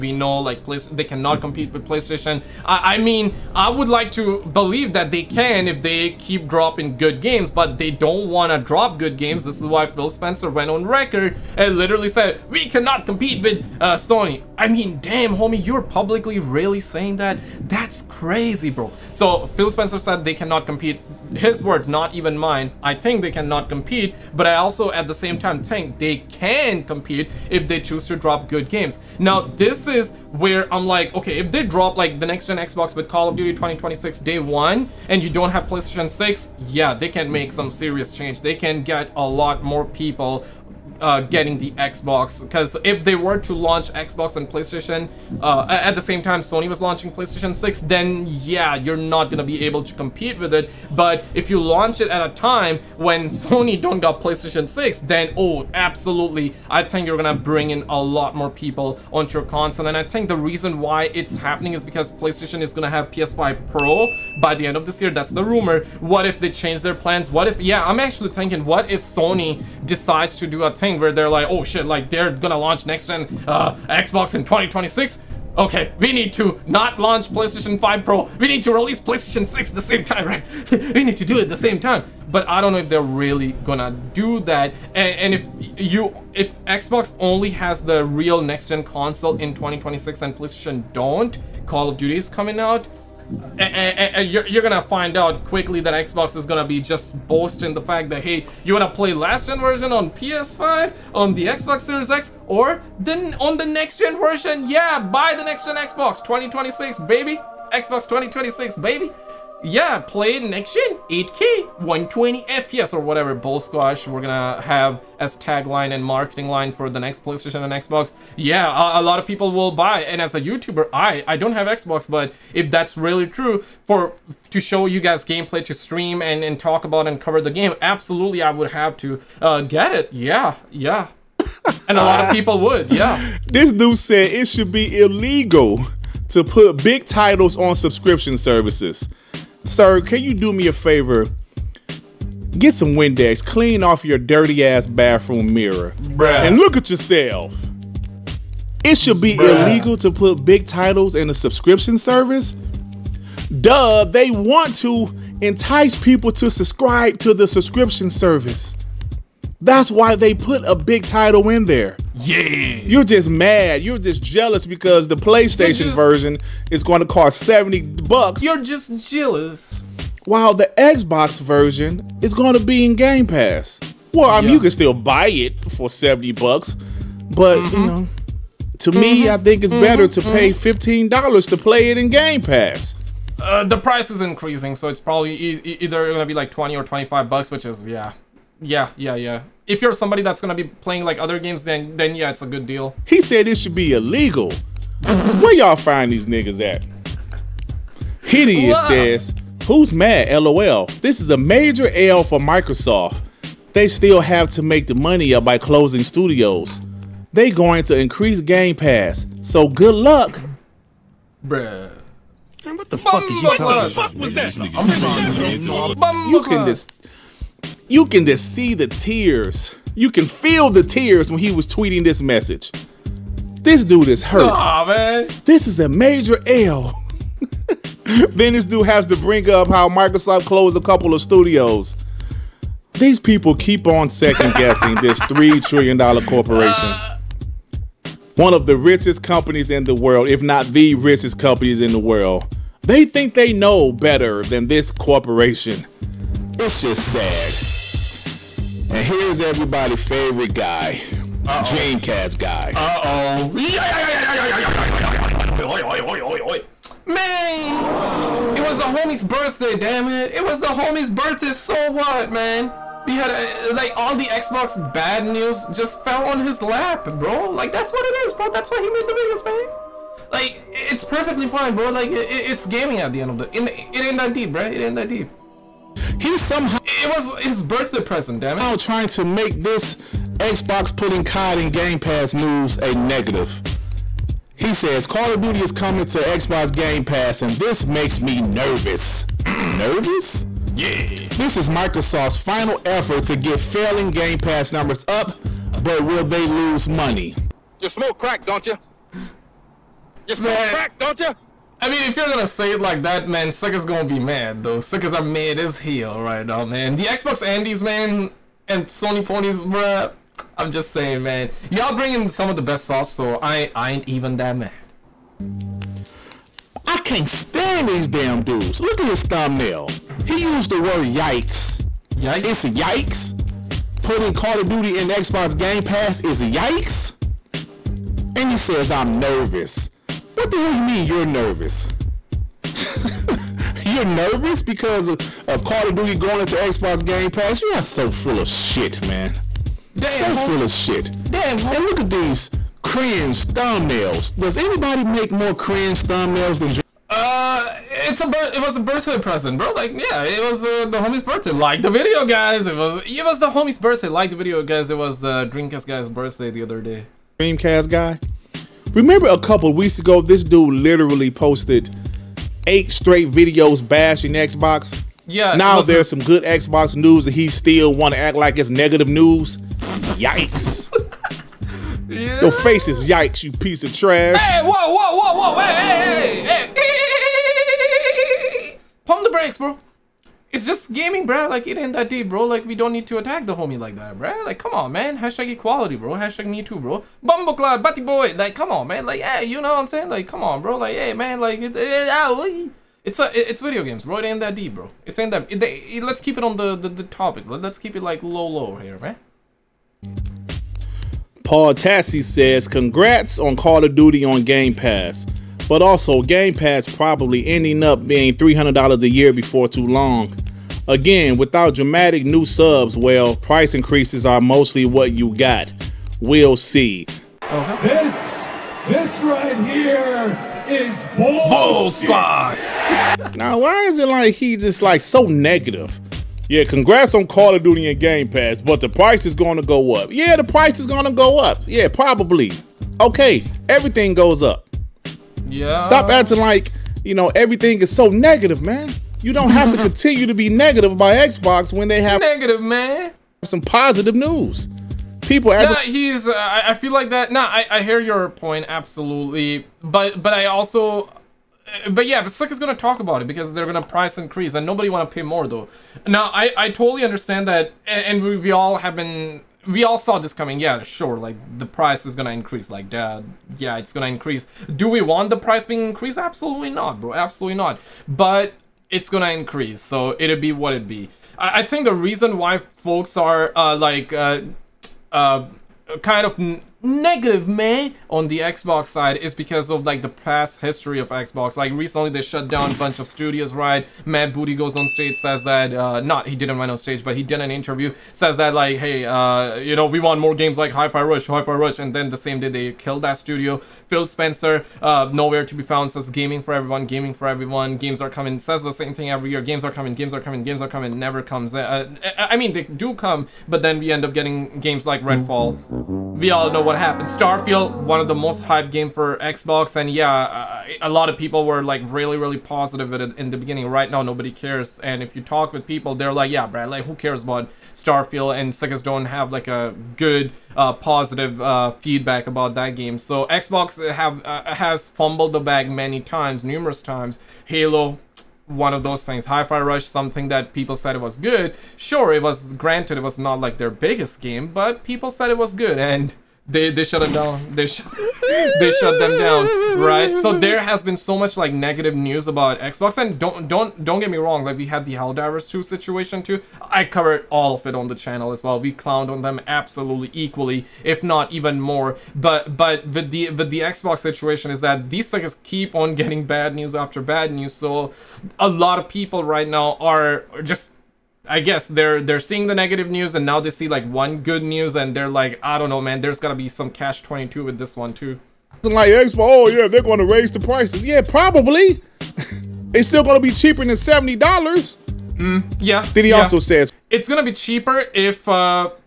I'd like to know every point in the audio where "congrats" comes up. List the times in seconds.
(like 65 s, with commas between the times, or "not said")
402 s, 426 s.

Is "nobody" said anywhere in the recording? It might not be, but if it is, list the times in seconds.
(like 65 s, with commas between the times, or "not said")
454 s, 514 s.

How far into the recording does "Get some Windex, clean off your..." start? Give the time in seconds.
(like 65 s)
142 s.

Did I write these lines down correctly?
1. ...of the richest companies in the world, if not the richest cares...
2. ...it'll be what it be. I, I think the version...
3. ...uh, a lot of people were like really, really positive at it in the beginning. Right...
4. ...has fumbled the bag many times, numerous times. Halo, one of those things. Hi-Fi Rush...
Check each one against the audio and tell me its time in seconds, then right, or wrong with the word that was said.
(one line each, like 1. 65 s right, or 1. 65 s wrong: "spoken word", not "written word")
1. 238 s wrong: "companies", not "cares"
2. 470 s wrong: "reason", not "version"
3. 510 s right
4. 524 s right.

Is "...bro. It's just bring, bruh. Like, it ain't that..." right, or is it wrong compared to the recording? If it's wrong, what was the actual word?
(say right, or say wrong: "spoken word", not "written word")
wrong: "gaming", not "bring".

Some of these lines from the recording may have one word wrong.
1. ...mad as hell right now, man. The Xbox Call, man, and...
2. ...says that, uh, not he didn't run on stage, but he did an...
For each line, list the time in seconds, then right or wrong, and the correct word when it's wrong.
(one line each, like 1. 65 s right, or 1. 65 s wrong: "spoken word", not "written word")
1. 305 s wrong: "Andes", not "Call"
2. 485 s right.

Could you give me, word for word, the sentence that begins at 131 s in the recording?
and a lot of people would.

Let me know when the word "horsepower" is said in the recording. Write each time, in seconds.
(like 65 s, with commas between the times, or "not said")
not said.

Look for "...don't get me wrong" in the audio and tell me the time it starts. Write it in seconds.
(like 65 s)
543 s.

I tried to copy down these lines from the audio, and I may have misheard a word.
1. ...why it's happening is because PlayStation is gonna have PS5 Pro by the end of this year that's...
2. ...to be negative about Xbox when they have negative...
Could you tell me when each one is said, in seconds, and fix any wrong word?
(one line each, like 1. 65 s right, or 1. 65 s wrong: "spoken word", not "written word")
1. 60 s right
2. 440 s right.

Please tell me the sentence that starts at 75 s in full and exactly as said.
Okay, we need to not launch PlayStation 5 Pro.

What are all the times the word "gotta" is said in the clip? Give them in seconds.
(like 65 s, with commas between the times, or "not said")
566 s.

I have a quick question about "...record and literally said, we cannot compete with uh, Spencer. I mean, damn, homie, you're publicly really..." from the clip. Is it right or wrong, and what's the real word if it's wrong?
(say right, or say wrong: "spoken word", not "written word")
wrong: "Sony", not "Spencer".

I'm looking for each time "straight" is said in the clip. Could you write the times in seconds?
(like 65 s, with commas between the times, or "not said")
362 s.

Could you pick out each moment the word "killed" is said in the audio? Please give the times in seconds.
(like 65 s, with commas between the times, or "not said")
492 s.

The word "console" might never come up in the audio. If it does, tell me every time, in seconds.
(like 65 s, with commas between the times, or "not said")
59 s, 88 s.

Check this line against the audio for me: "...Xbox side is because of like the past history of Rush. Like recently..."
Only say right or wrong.
wrong.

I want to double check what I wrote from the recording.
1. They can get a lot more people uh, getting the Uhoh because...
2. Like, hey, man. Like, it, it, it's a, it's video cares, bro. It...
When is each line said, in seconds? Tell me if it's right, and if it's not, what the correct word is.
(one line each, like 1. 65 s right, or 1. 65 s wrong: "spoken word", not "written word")
1. 38 s wrong: "Xbox", not "Uhoh"
2. 390 s wrong: "games", not "cares".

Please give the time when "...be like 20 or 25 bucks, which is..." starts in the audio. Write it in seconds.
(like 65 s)
186 s.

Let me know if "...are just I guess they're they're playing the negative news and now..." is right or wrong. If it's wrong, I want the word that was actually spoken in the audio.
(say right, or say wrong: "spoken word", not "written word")
wrong: "seeing", not "playing".